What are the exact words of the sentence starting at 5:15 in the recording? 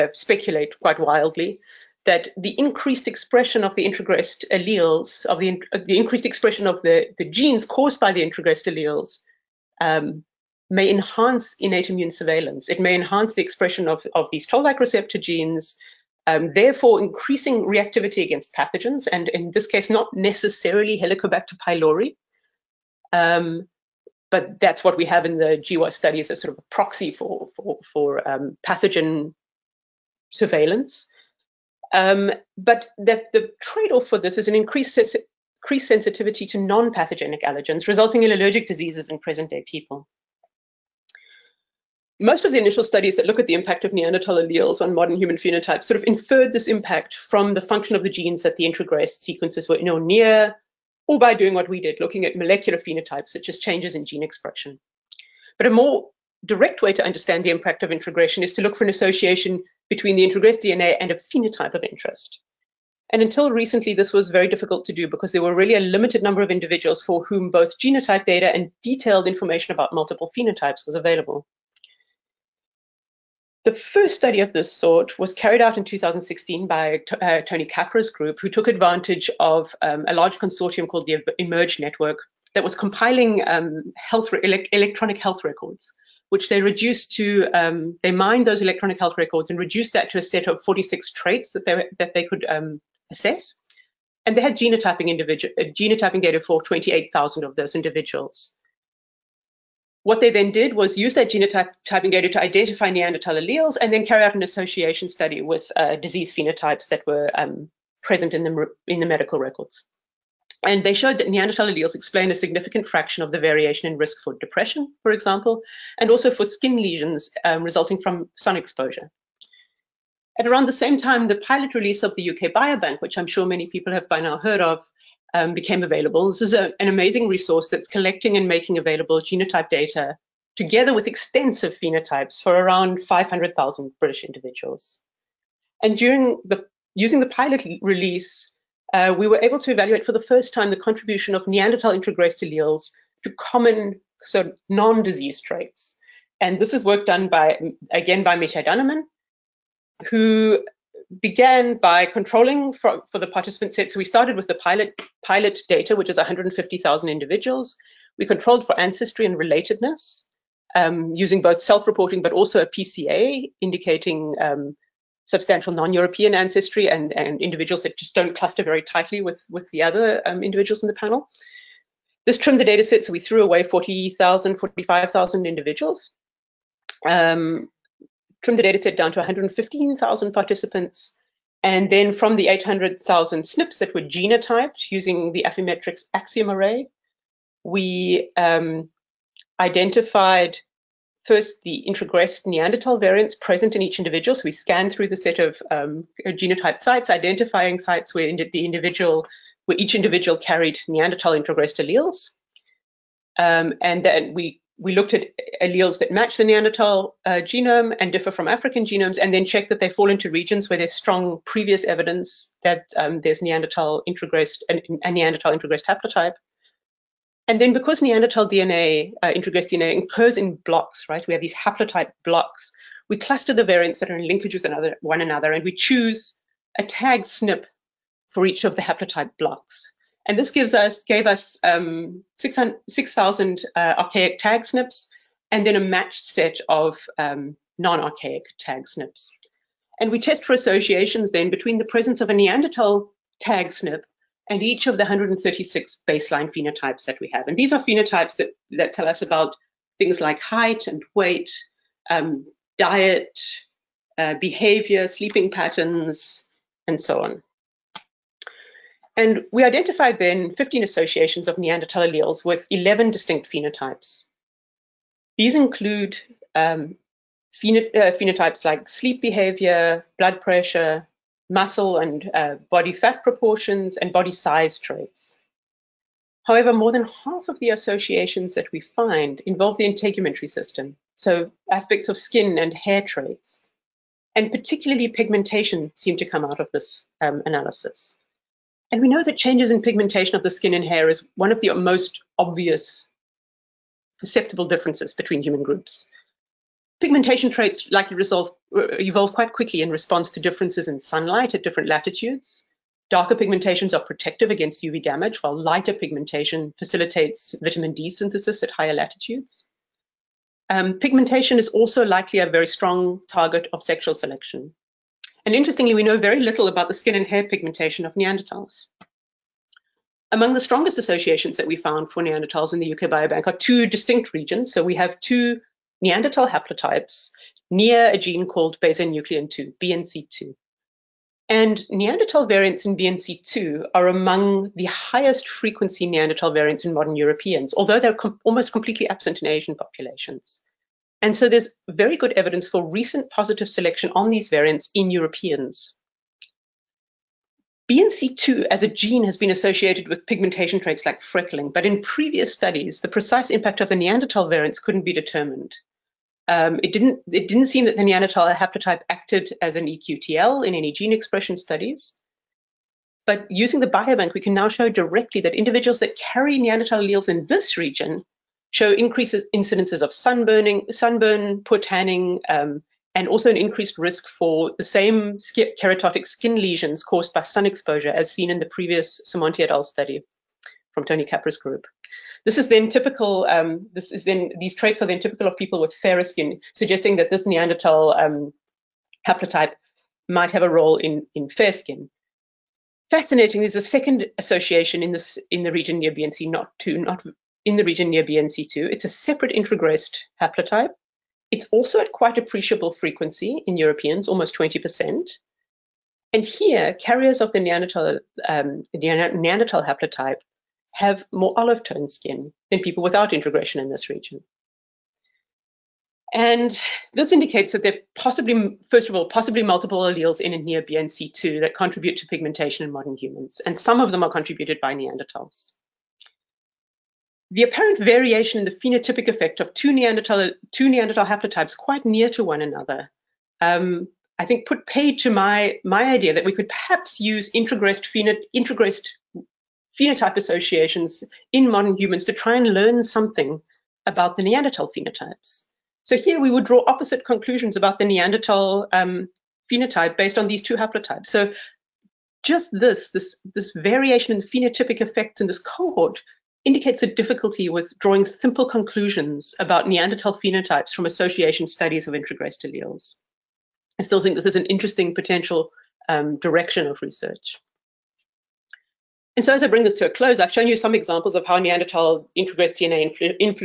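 And interestingly, we know very little about the skin and hair pigmentation of Neanderthals.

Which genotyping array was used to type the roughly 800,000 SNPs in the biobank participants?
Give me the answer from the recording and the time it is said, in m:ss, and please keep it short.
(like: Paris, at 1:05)
Affymetrix Axiom array, at 3:05.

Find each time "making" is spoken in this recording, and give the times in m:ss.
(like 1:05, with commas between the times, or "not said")
2:08.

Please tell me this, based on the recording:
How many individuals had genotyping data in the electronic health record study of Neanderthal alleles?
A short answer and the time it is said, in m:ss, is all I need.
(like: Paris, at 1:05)
28,000, at 1:36.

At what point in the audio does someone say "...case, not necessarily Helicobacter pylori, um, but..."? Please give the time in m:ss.
0:19.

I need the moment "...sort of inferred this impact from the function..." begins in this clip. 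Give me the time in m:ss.
0:45.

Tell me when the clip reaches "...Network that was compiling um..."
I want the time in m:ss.
1:21.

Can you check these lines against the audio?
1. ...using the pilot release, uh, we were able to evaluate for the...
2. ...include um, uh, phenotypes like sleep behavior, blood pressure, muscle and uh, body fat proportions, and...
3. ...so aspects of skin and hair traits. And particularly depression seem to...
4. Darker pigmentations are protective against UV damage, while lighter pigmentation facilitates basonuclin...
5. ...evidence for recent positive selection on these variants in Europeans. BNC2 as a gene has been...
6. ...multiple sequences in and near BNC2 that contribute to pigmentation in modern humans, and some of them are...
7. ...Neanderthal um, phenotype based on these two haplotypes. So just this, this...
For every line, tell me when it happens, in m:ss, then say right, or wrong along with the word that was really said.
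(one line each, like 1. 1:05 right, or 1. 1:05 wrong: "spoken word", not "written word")
1. 2:16 right
2. 4:25 right
3. 4:41 wrong: "pigmentation", not "depression"
4. 5:03 wrong: "vitamin", not "basonuclin"
5. 5:42 right
6. 6:59 wrong: "alleles", not "sequences"
7. 7:28 right.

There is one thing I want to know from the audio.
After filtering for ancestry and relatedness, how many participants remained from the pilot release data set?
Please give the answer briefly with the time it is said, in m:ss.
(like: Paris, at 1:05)
115,000, at 2:59.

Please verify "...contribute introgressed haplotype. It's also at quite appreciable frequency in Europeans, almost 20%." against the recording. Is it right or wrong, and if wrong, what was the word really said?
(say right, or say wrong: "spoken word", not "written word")
wrong: "separate", not "contribute".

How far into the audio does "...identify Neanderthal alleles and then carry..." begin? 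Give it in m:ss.
1:42.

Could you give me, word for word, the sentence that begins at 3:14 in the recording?
So we scanned through the set of um, genotyped sites, identifying sites where the individual, where each individual carried Neanderthal introgressed alleles.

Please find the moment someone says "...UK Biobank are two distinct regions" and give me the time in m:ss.
5:22.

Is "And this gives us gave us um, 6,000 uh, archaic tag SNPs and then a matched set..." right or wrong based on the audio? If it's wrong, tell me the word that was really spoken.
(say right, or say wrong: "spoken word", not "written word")
right.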